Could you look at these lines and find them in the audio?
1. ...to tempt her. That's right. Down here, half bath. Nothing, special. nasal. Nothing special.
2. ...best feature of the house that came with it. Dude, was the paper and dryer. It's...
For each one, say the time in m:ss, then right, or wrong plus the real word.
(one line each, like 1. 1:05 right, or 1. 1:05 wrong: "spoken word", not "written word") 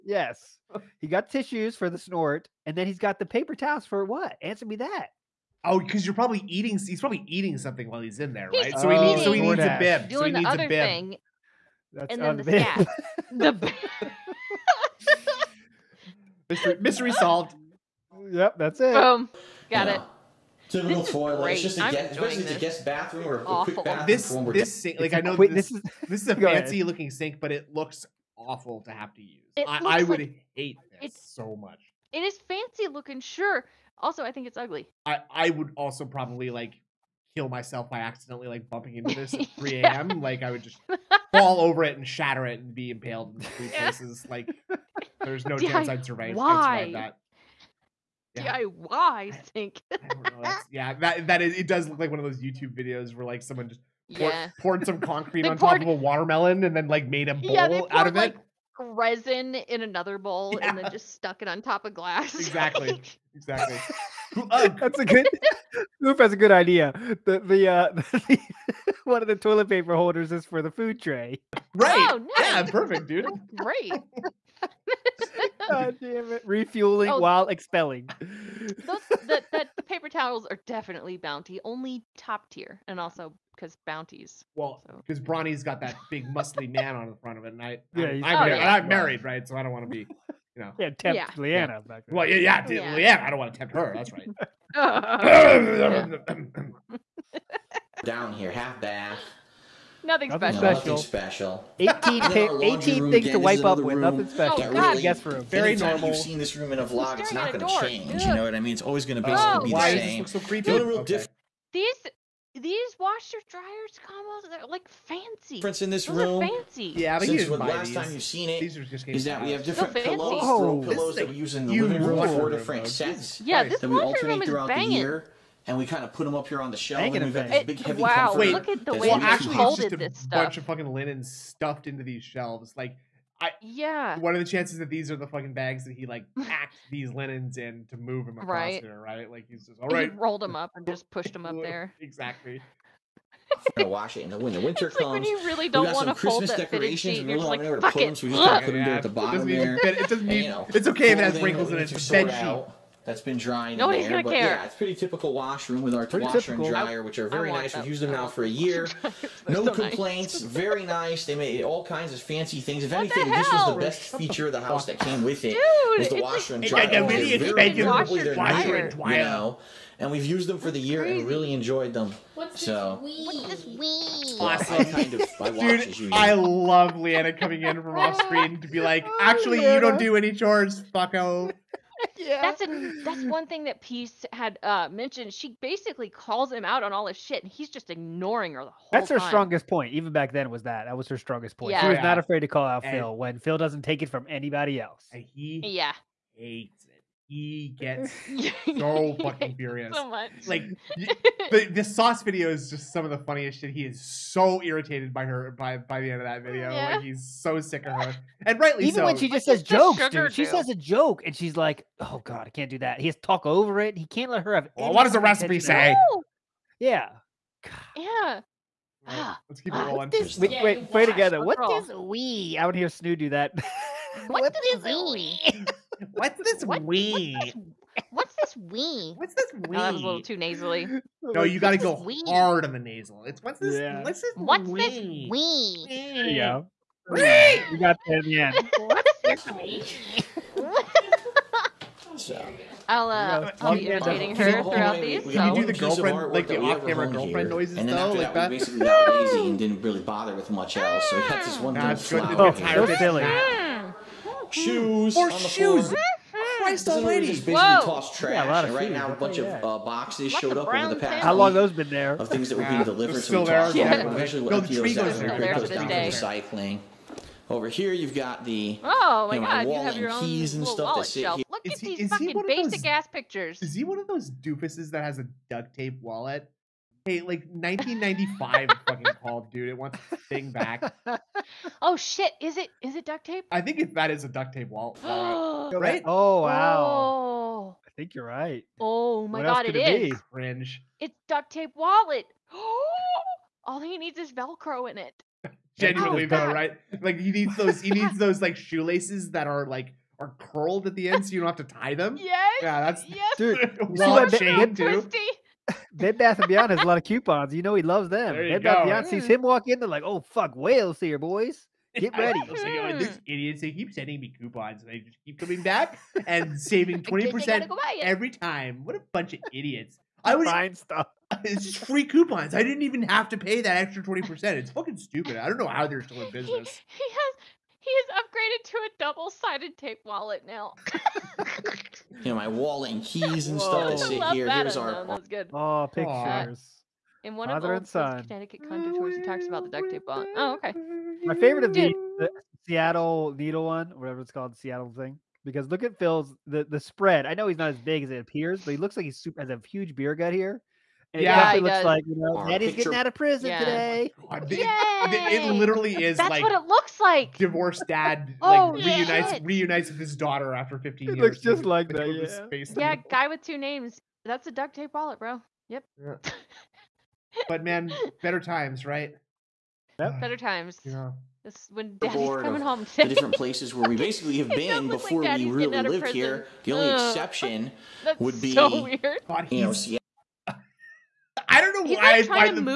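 1. 1:33 wrong: "special", not "nasal"
2. 2:43 wrong: "washer", not "paper".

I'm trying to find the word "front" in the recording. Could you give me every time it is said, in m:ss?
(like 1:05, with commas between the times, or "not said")
1:27.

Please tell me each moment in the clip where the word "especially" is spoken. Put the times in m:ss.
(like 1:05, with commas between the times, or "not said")
0:22.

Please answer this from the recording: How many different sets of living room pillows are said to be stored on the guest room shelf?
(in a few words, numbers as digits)
4.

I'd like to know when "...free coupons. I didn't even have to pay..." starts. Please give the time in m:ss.
5:21.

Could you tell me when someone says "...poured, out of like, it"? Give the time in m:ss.
0:57.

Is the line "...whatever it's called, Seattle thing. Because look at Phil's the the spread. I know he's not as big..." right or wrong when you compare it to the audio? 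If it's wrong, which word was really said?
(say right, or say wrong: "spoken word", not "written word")
right.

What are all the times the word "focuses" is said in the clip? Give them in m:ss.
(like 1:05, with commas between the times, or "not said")
not said.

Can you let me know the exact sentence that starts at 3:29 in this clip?
when she just says jokes, dude.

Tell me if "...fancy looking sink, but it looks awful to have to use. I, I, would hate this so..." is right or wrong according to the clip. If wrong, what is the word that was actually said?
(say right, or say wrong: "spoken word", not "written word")
right.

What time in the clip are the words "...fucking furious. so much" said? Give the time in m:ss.
3:19.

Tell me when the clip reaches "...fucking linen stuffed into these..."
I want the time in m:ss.
2:10.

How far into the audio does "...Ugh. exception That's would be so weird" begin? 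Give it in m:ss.
6:16.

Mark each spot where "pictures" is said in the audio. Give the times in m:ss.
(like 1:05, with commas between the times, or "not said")
4:33, 5:35.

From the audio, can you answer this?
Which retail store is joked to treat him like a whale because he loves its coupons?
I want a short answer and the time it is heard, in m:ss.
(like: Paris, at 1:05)
Bed Bath and Beyond, at 5:05.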